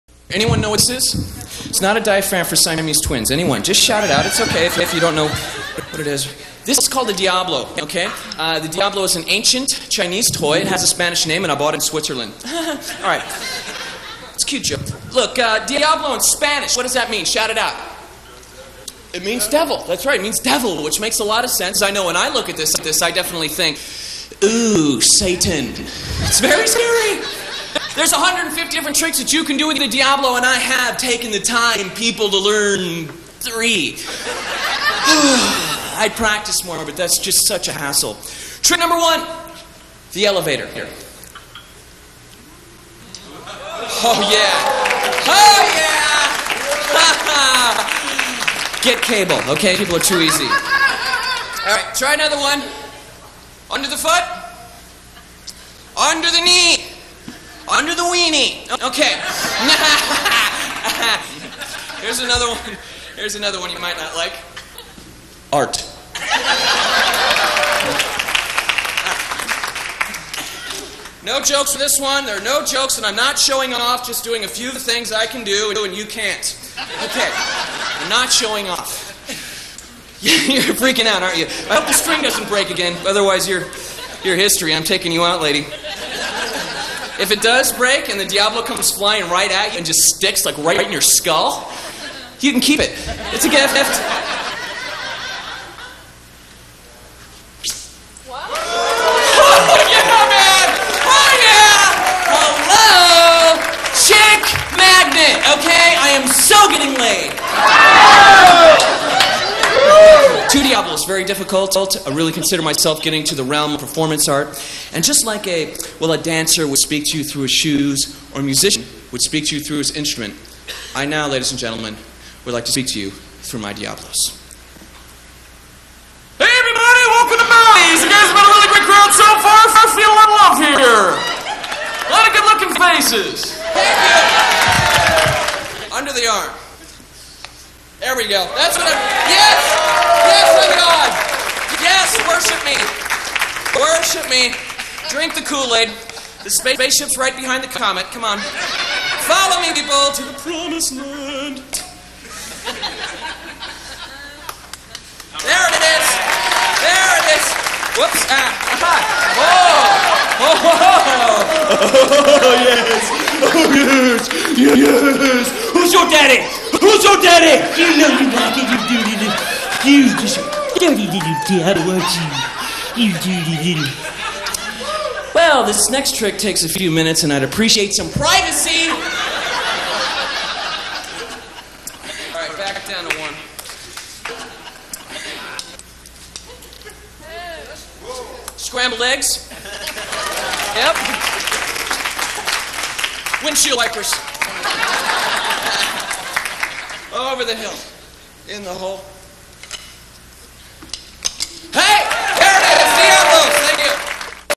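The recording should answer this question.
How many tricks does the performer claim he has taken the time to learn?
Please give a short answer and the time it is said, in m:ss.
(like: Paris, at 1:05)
3, at 0:33.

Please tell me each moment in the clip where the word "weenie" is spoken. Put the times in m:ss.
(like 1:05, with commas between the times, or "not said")
0:58.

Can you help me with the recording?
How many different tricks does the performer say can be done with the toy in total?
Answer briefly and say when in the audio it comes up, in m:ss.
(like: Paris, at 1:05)
150, at 0:28.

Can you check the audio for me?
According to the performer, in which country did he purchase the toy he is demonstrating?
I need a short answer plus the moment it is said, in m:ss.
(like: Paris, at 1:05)
Switzerland, at 0:11.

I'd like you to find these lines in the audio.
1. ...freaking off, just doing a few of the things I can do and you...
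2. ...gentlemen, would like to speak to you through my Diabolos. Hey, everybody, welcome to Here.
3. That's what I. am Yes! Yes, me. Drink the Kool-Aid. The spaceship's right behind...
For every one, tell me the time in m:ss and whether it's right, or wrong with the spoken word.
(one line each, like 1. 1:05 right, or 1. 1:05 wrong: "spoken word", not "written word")
1. 1:13 wrong: "showing", not "freaking"
2. 2:01 wrong: "Mounties", not "Here"
3. 2:18 right.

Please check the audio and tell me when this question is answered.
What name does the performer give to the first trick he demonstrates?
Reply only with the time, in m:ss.
0:40.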